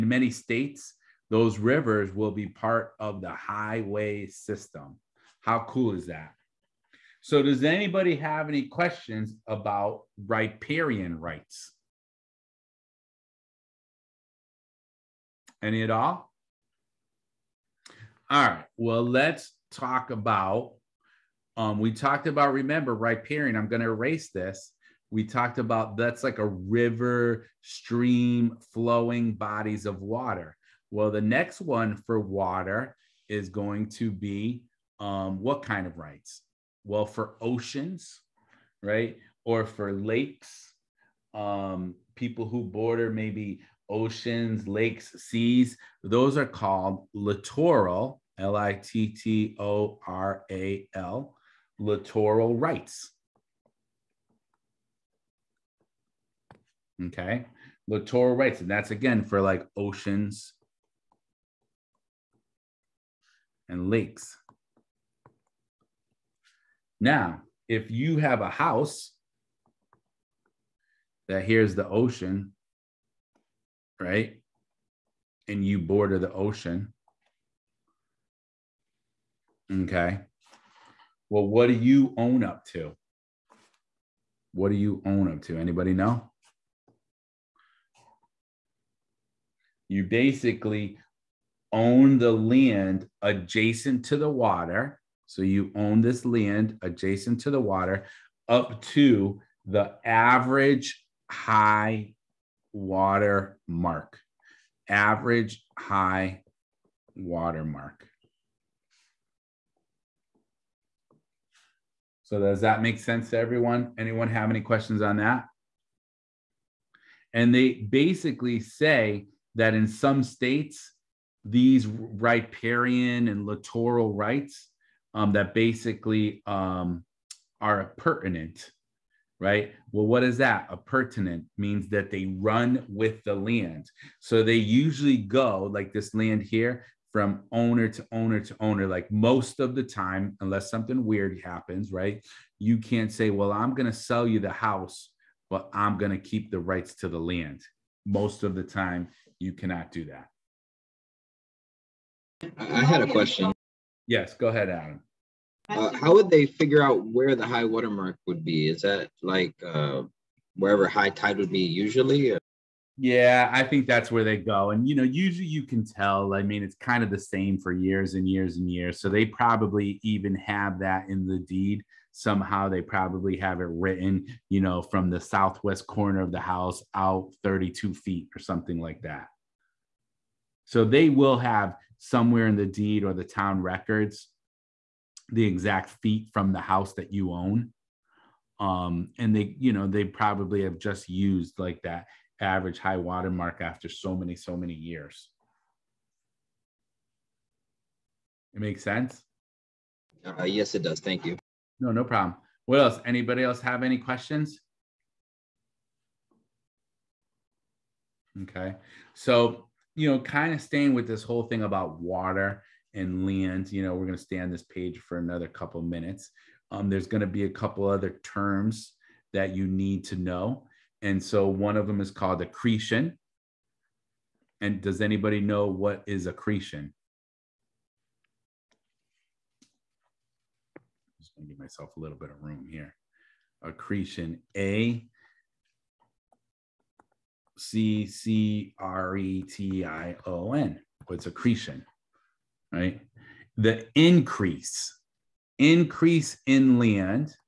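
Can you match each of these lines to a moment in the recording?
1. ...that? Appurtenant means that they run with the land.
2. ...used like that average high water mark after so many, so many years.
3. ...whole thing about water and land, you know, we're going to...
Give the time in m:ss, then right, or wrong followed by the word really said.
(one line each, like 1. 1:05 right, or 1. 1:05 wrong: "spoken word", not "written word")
1. 2:10 right
2. 3:11 right
3. 3:31 right.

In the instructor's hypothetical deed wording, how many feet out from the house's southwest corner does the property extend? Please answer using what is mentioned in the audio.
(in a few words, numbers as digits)
32 feet.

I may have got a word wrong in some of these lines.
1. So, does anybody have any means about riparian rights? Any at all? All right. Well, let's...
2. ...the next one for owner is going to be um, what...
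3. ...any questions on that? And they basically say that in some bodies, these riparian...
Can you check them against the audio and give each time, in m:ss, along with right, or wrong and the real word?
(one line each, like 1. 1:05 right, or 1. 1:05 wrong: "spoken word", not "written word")
1. 0:07 wrong: "questions", not "means"
2. 0:31 wrong: "water", not "owner"
3. 1:54 wrong: "states", not "bodies".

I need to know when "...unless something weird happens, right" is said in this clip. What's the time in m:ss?
2:20.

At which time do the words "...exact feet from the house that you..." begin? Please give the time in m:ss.
3:05.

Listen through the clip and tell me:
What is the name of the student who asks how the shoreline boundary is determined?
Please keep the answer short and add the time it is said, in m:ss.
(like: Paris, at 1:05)
Adam, at 2:34.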